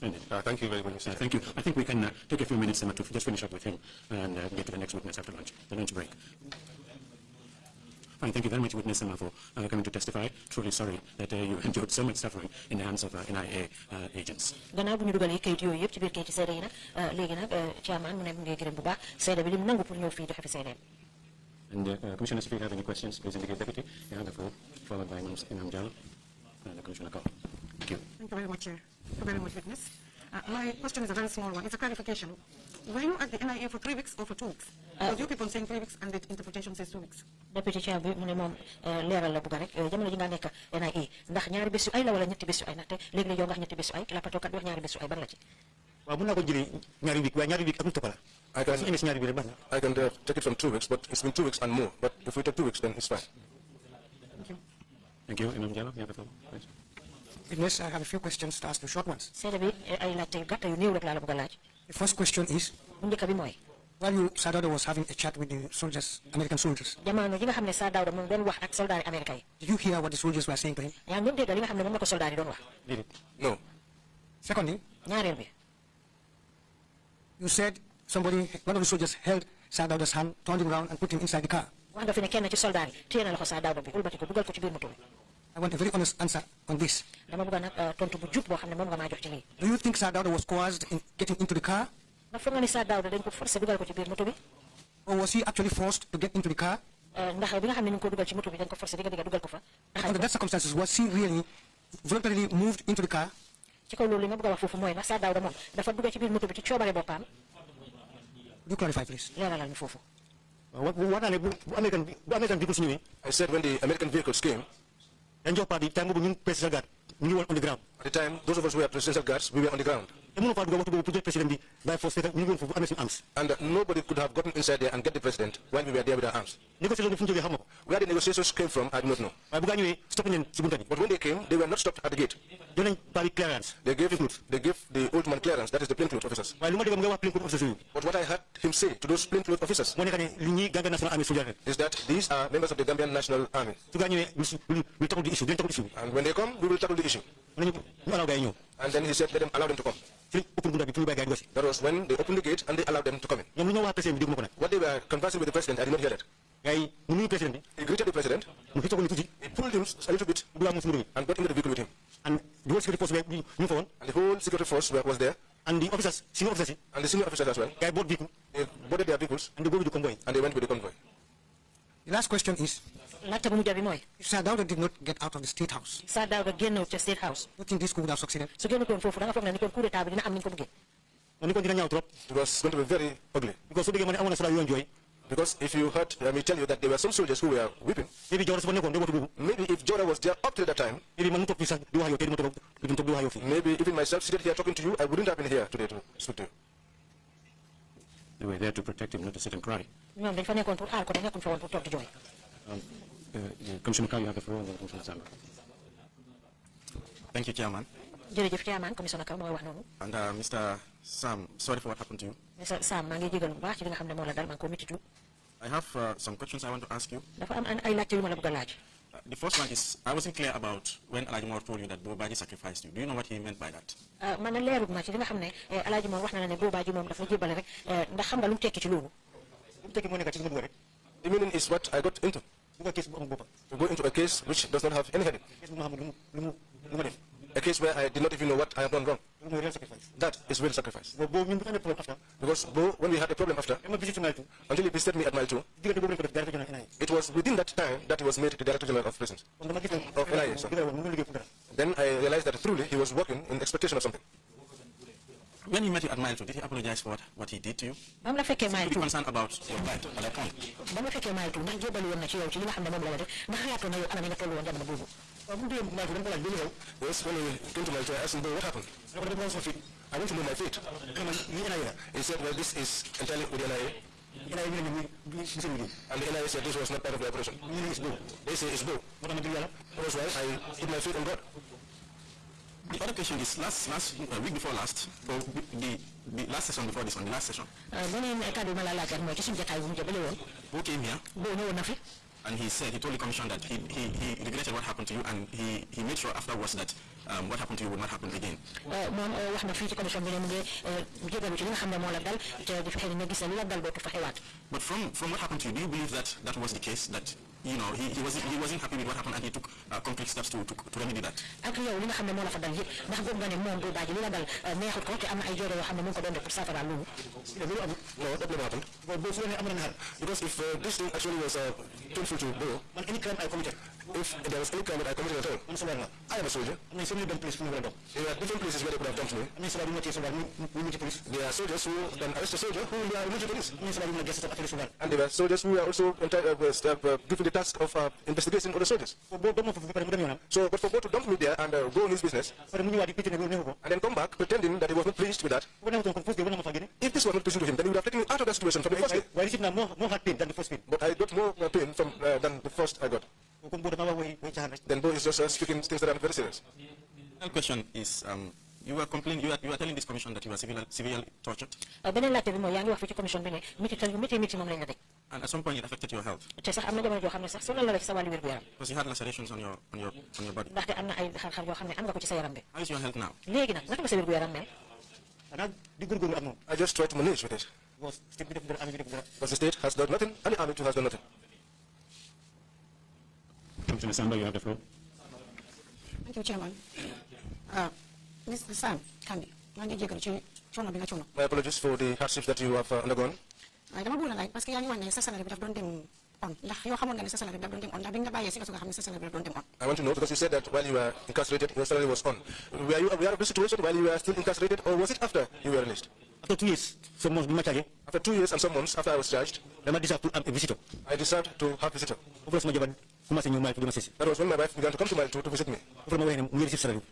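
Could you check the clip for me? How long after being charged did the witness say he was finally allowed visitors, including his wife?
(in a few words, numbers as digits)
two years and some months.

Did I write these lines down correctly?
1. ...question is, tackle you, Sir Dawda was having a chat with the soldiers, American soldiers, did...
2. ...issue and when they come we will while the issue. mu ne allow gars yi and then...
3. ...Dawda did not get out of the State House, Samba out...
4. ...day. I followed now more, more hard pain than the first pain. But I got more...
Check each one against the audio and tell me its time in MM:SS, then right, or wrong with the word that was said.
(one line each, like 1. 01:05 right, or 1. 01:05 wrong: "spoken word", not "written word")
1. 01:02 wrong: "while", not "tackle"
2. 02:25 wrong: "tackle", not "while"
3. 02:54 wrong: "Sir", not "Samba"
4. 05:49 wrong: "received", not "followed".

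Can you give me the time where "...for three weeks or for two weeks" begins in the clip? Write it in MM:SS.
00:33.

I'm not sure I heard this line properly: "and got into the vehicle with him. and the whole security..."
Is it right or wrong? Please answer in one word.
right.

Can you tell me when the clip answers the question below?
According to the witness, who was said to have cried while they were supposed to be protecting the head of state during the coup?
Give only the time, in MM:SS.
03:06.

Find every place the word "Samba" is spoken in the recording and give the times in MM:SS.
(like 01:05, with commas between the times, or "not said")
03:25, 06:24.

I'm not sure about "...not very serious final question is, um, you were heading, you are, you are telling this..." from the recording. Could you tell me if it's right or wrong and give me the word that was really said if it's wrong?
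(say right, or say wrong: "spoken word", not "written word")
wrong: "complaining", not "heading".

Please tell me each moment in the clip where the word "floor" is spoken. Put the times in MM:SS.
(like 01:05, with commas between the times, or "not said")
00:24, 00:56, 03:24, 06:24.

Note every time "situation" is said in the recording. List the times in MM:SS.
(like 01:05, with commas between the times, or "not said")
05:48, 06:43.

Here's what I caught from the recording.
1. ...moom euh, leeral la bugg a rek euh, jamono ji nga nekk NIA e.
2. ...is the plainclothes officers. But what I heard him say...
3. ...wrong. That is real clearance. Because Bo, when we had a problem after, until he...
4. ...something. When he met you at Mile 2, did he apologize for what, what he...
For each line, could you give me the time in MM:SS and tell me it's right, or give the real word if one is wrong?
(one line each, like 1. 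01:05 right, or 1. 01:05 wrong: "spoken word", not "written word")
1. 00:38 right
2. 02:15 right
3. 03:59 wrong: "sacrifice", not "clearance"
4. 04:14 right.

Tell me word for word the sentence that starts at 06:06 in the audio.
te sax am na jamono joo xam ne sax sonal na la ci sa wàllu wér gu yaram.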